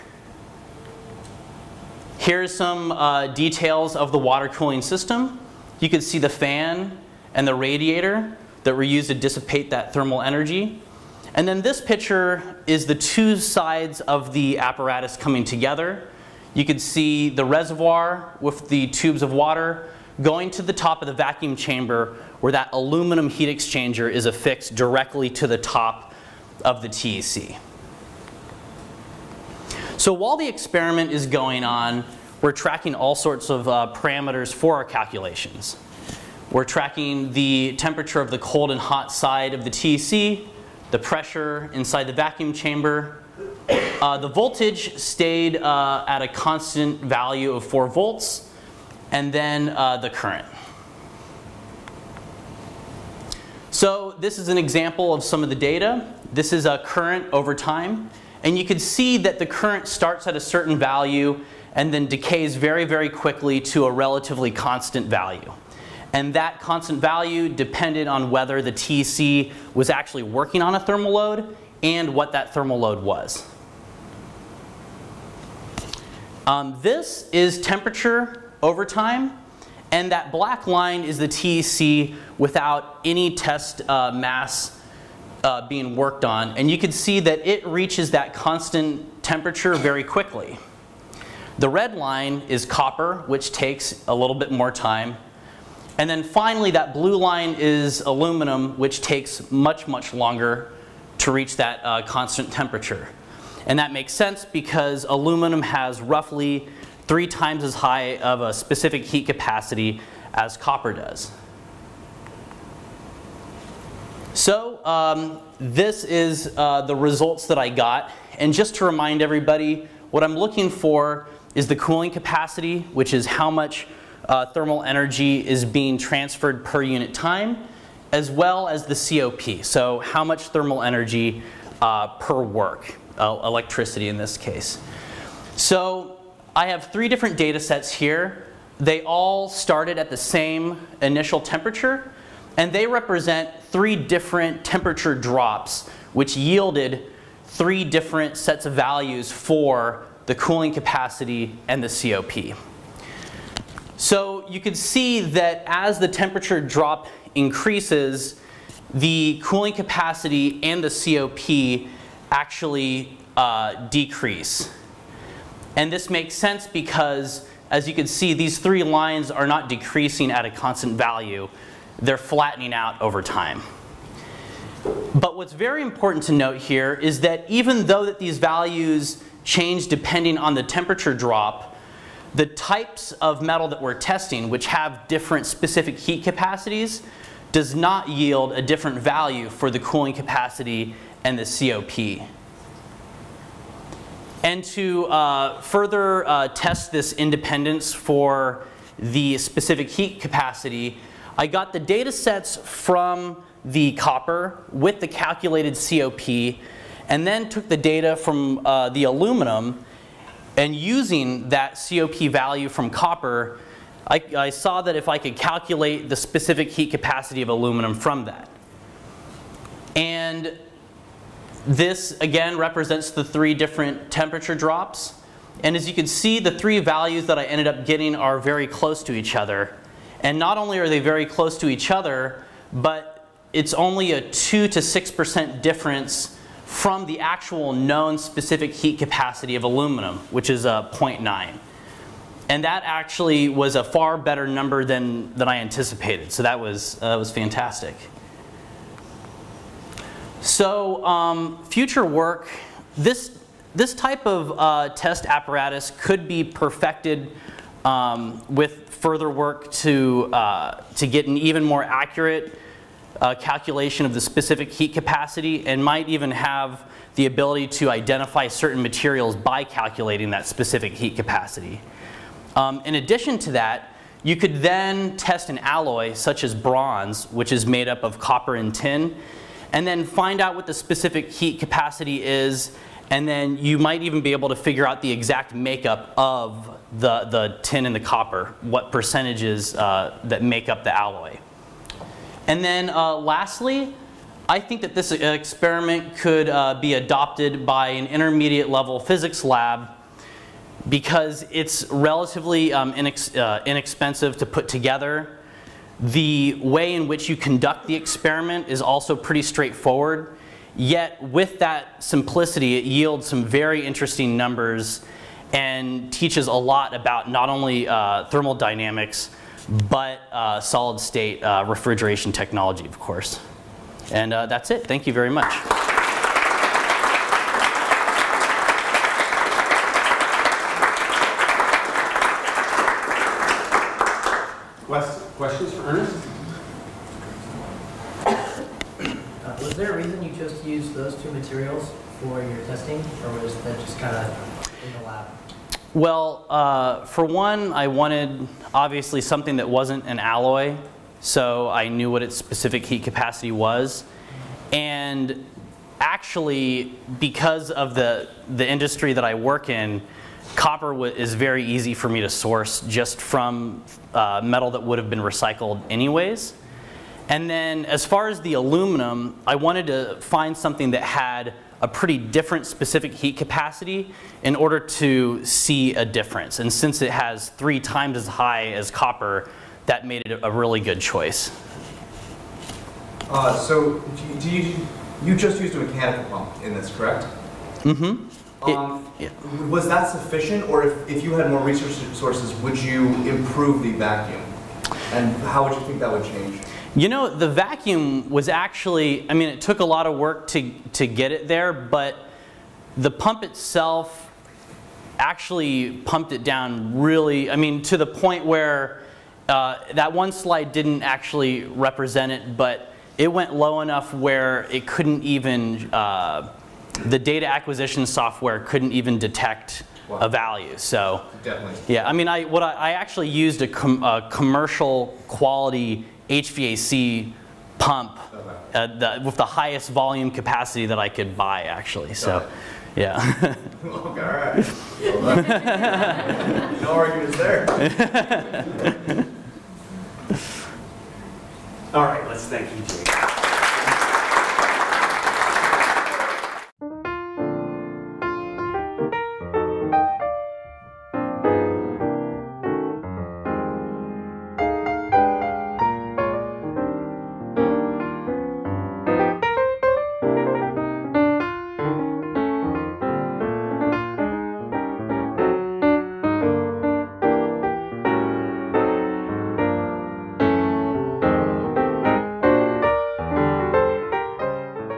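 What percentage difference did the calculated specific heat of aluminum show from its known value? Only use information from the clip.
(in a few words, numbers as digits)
2 to 6%.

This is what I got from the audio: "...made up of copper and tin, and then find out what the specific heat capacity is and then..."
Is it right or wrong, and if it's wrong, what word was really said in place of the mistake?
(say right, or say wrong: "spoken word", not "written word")
right.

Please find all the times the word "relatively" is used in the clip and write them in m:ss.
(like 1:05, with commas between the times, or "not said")
1:03, 5:01.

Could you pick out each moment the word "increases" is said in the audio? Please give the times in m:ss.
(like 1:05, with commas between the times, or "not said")
2:37.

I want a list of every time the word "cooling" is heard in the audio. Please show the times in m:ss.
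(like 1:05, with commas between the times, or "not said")
0:04, 2:01, 2:30, 2:39, 3:09.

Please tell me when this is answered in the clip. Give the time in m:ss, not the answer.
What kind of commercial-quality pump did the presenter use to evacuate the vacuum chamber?
7:06.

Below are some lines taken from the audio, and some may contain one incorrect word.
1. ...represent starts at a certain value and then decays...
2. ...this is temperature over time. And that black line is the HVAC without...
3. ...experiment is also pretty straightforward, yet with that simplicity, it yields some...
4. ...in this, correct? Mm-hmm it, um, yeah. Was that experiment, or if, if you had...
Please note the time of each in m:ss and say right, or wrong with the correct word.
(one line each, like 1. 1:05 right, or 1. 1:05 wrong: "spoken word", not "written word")
1. 0:59 wrong: "current", not "represent"
2. 1:16 wrong: "TEC", not "HVAC"
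3. 5:07 right
4. 6:26 wrong: "sufficient", not "experiment".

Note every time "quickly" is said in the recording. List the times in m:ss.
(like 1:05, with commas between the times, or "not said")
1:03, 1:30.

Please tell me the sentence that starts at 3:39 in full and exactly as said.
And this again represents the three different temperature drops.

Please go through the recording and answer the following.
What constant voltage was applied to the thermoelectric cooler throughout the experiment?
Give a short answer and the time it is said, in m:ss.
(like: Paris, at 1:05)
4 volts, at 0:47.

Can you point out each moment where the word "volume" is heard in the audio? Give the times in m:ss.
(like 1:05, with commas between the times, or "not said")
7:09.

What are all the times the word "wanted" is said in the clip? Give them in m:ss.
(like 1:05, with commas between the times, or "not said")
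5:47, 6:09.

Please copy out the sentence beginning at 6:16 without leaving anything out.
And since it has three times as high as copper, that made it a really good choice.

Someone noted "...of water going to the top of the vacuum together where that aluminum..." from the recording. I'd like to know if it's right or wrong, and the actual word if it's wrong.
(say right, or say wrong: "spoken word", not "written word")
wrong: "chamber", not "together".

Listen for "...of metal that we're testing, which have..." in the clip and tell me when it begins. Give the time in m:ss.
3:03.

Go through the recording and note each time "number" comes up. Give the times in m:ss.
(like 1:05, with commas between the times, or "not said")
4:04, 5:14.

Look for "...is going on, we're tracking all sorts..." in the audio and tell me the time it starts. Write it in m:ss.
0:31.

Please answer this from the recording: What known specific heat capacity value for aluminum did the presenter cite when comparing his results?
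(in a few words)
0.9.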